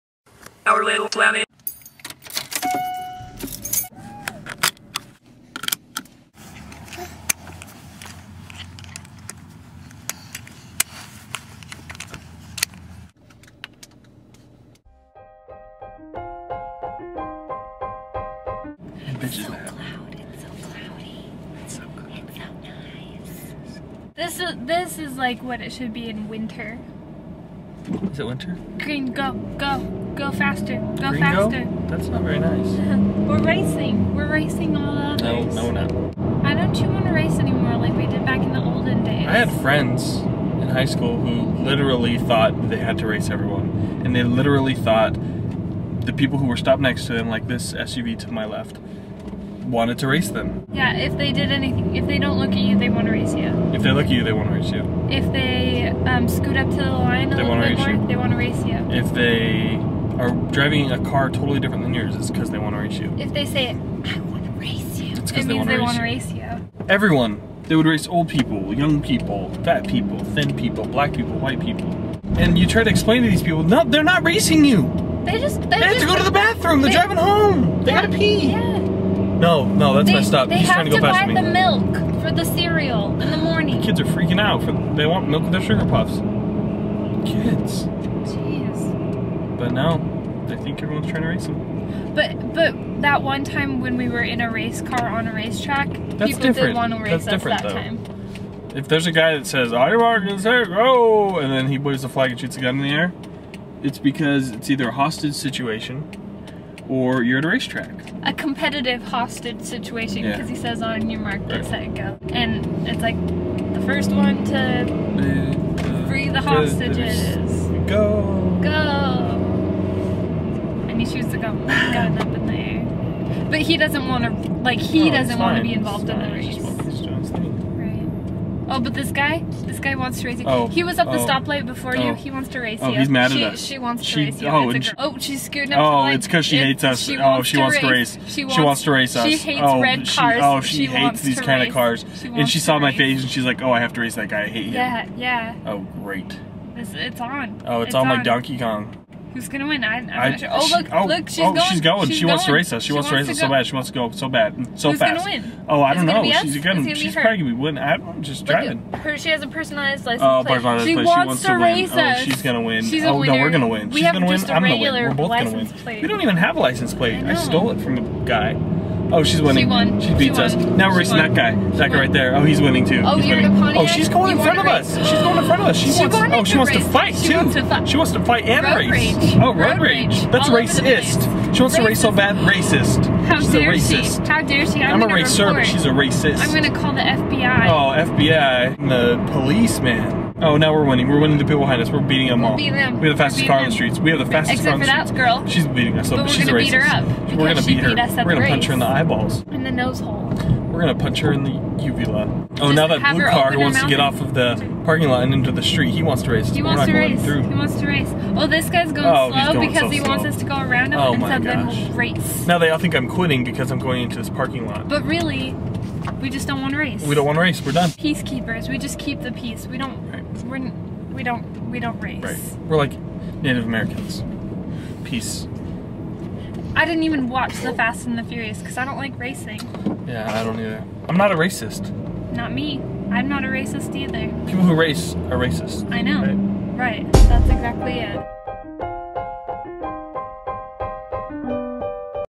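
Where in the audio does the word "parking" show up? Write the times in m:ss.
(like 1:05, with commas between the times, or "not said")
3:24, 3:34.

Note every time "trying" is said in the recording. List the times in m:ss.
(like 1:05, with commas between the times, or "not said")
1:20, 1:31.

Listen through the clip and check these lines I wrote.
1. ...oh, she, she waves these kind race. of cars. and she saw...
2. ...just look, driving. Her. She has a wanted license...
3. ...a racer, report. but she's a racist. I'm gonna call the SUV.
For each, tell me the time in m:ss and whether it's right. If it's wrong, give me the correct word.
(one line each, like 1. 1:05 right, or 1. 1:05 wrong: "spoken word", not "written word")
1. 2:20 wrong: "hates", not "waves"
2. 2:38 wrong: "personalized", not "wanted"
3. 3:05 wrong: "FBI", not "SUV".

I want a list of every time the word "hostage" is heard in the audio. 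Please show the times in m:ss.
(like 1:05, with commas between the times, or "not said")
1:44, 1:49, 1:56.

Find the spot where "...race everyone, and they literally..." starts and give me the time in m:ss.
0:43.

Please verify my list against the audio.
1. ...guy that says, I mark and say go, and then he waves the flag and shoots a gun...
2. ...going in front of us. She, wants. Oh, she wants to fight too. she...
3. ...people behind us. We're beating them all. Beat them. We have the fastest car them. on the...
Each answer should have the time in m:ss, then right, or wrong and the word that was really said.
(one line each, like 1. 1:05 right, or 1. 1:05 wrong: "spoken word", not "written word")
1. 1:39 right
2. 2:55 right
3. 3:11 right.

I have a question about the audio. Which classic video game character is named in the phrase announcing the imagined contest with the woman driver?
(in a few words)
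Donkey Kong.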